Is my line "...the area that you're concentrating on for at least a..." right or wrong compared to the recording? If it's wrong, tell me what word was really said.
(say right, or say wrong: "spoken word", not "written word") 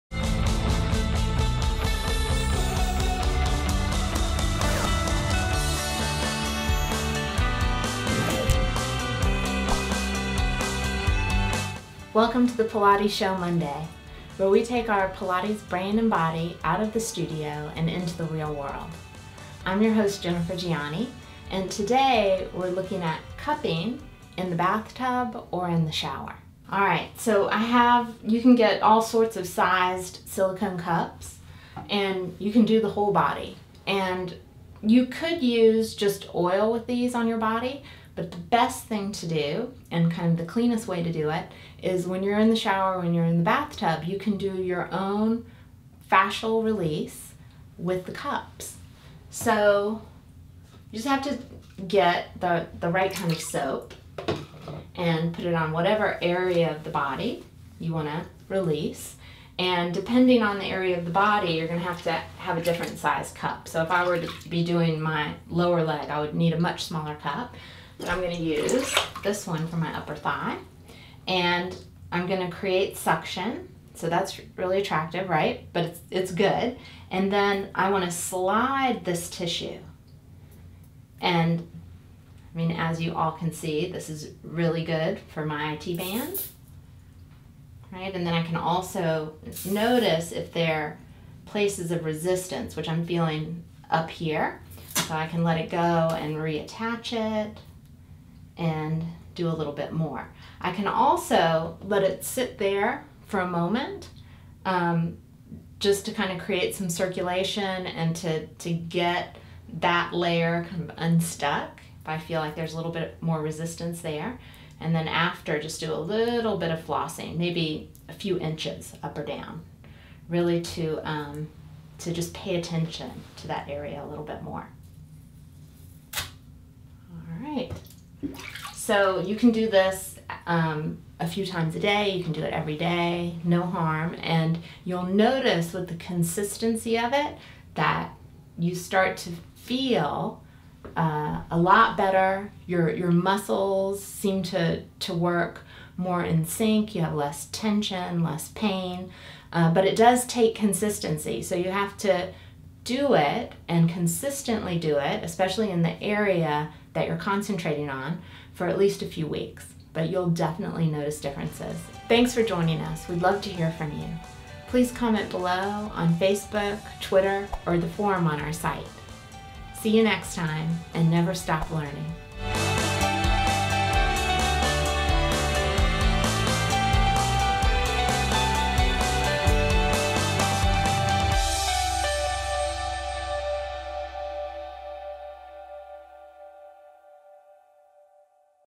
right.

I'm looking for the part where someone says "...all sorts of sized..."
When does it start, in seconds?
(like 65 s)
28 s.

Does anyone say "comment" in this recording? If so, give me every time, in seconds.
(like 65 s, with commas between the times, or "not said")
164 s.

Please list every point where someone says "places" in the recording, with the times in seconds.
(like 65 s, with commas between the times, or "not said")
91 s.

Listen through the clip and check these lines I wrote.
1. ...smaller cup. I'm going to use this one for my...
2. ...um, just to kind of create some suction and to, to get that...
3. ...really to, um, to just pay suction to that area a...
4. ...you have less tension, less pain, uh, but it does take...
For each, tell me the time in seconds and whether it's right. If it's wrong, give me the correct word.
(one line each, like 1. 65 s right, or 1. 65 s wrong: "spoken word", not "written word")
1. 66 s right
2. 104 s wrong: "circulation", not "suction"
3. 120 s wrong: "attention", not "suction"
4. 146 s right.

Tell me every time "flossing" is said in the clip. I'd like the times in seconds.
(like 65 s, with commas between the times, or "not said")
116 s.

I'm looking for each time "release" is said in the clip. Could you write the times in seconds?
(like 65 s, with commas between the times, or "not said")
46 s, 58 s.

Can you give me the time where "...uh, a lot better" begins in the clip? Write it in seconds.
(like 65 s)
140 s.